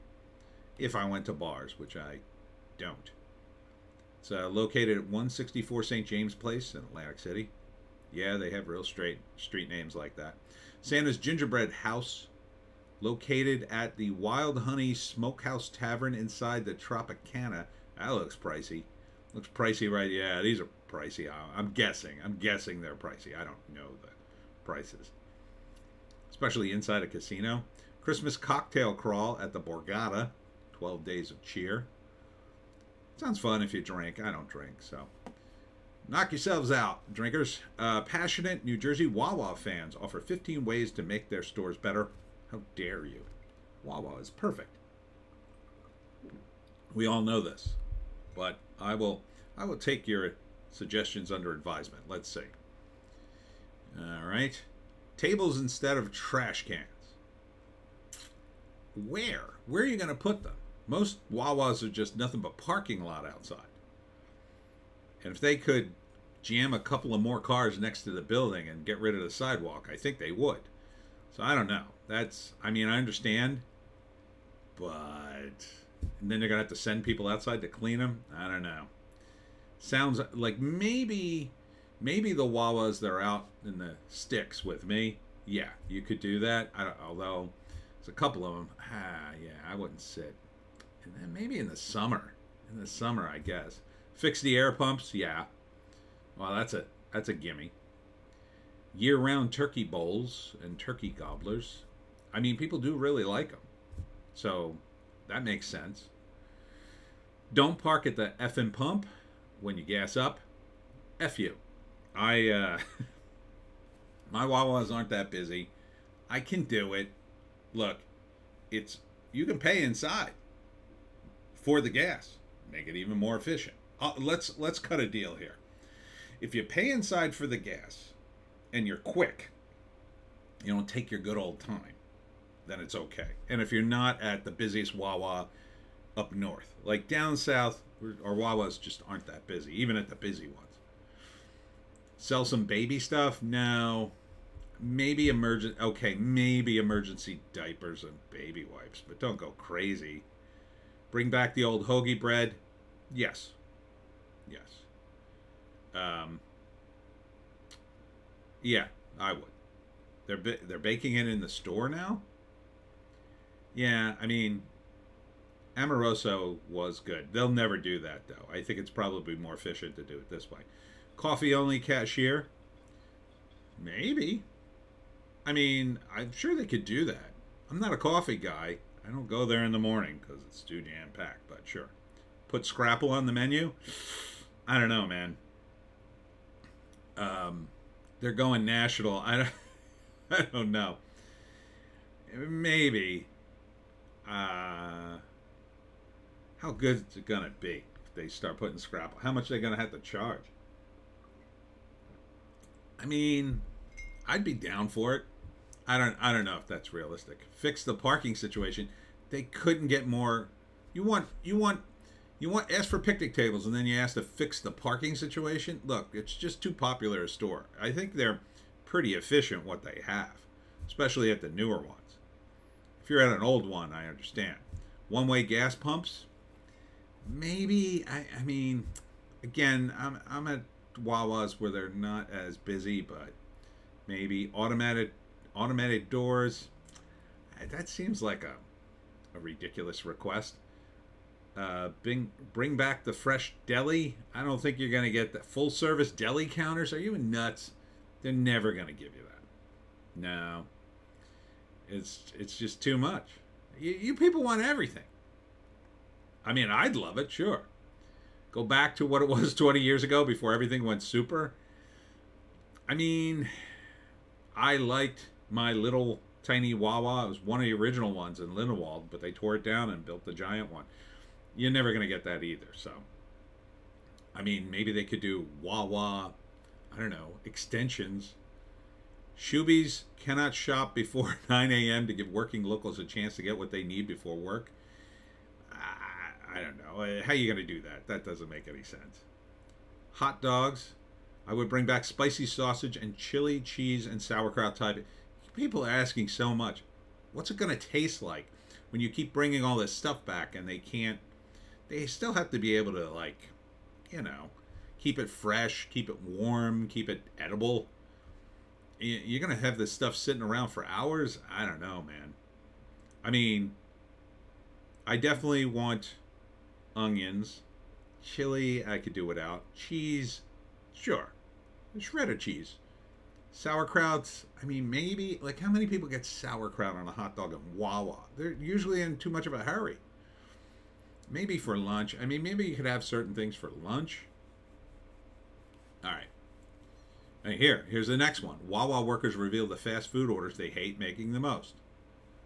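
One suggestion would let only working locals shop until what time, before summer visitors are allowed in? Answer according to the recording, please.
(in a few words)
9 a.m.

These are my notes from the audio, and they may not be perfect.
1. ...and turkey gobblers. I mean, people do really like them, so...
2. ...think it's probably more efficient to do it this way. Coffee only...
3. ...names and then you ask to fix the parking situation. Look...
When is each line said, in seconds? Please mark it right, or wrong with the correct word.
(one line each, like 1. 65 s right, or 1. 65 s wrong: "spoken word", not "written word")
1. 100 s right
2. 168 s right
3. 213 s wrong: "tables", not "names".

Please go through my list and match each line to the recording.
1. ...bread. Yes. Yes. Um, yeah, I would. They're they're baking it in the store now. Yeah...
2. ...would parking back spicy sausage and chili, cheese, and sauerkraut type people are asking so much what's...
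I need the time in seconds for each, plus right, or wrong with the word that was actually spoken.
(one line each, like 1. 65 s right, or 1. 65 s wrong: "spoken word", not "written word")
1. 152 s right
2. 291 s wrong: "bring", not "parking".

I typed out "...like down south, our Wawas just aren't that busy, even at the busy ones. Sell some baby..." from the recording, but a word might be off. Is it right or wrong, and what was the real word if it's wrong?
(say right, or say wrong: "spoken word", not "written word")
right.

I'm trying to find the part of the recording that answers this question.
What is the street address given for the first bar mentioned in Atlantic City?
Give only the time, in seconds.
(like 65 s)
5 s.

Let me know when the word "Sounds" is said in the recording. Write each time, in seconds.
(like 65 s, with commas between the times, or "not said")
33 s, 79 s.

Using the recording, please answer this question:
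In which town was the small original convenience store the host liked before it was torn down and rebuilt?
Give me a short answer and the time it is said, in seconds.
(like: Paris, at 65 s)
Lindenwold, at 268 s.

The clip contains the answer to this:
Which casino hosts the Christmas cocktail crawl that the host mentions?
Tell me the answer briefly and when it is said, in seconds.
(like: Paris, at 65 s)
Borgata, at 29 s.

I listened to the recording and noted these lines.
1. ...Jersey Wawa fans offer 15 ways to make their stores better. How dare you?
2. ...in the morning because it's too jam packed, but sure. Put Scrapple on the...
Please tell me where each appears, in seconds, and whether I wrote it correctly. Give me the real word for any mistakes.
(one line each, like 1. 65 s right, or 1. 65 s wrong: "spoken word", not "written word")
1. 38 s right
2. 179 s right.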